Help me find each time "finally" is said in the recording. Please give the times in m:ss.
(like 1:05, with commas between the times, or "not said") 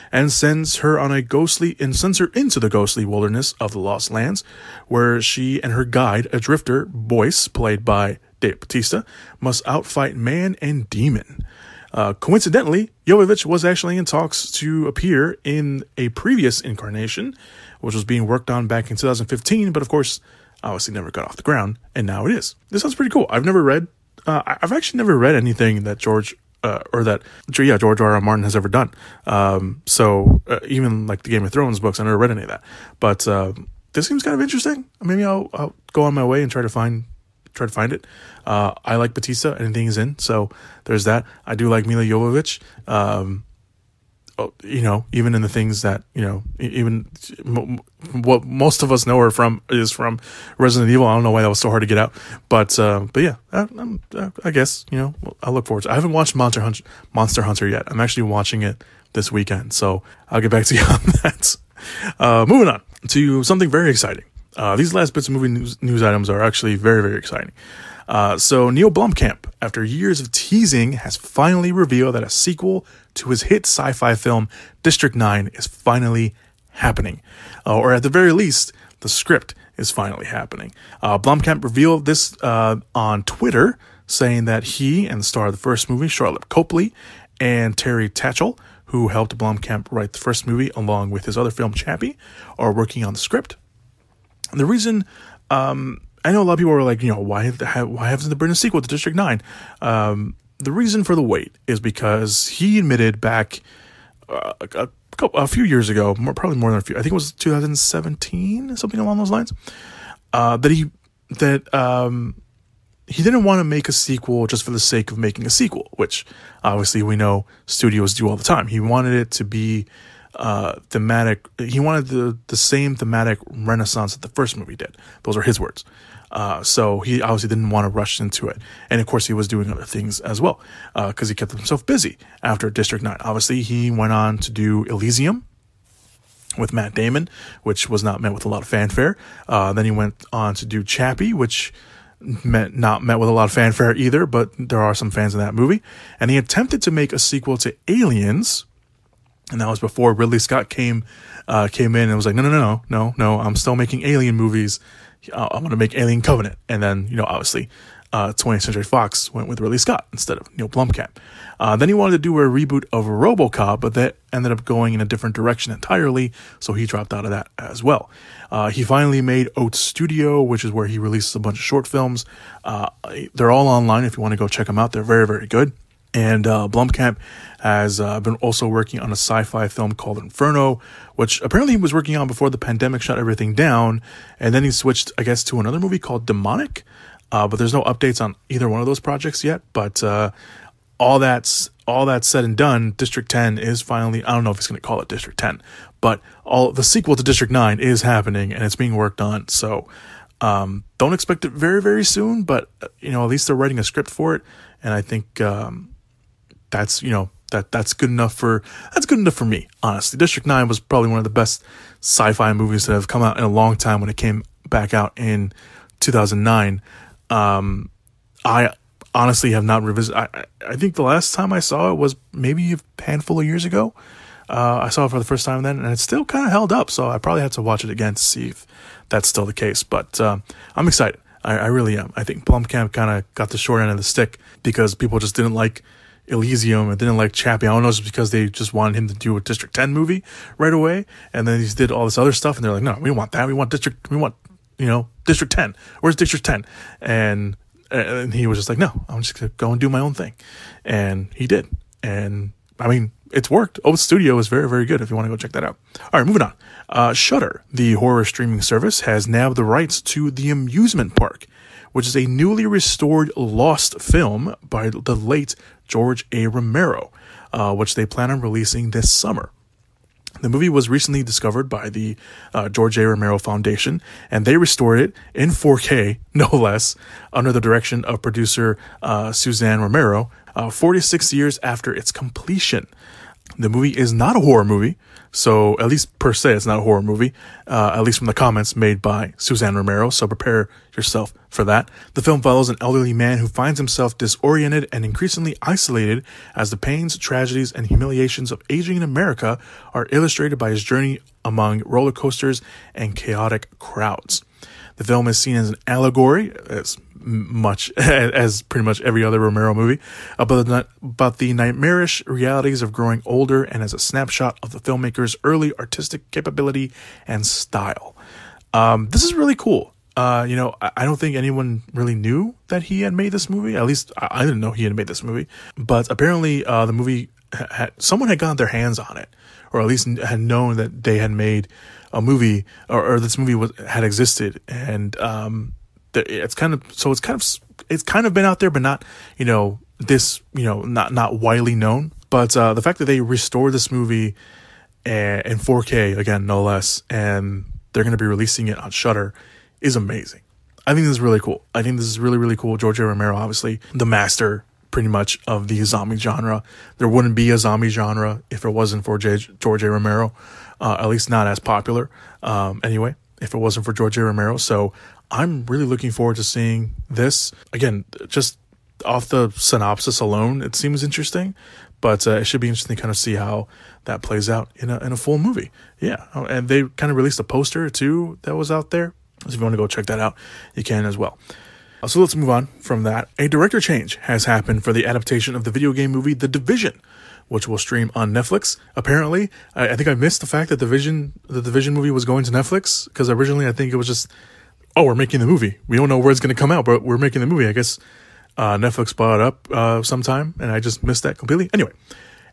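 1:11, 1:15, 1:19, 2:48, 3:13.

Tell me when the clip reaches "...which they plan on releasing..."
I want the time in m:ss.
4:27.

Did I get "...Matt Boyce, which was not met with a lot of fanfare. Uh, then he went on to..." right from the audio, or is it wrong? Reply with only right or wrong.
wrong.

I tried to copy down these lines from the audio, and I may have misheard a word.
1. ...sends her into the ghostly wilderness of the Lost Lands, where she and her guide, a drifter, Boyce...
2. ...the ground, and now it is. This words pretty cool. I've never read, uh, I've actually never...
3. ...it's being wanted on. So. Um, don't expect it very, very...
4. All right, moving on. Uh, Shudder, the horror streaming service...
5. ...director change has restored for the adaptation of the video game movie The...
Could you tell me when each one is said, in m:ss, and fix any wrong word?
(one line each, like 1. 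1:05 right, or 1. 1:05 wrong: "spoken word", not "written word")
1. 0:01 right
2. 0:21 wrong: "sounds", not "words"
3. 3:18 wrong: "worked", not "wanted"
4. 4:16 right
5. 6:23 wrong: "happened", not "restored".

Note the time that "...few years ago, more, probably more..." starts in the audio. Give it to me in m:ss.
1:45.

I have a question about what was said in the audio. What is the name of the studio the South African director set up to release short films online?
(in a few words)
Oat Studio.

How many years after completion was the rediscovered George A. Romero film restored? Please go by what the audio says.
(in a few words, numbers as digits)
46.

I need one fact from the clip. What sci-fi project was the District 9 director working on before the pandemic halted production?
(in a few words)
Inferno.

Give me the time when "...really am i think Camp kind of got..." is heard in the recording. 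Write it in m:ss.
3:51.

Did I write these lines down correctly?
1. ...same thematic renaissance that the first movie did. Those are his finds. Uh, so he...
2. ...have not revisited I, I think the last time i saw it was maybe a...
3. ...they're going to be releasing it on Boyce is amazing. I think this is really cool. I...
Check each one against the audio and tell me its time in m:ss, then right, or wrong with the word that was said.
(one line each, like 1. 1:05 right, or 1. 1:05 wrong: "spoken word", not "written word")
1. 2:02 wrong: "words", not "finds"
2. 3:39 right
3. 5:47 wrong: "Shudder", not "Boyce".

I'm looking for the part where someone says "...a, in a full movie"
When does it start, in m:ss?
6:14.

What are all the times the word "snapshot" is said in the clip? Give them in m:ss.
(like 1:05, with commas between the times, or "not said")
5:13.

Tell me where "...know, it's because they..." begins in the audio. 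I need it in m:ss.
3:57.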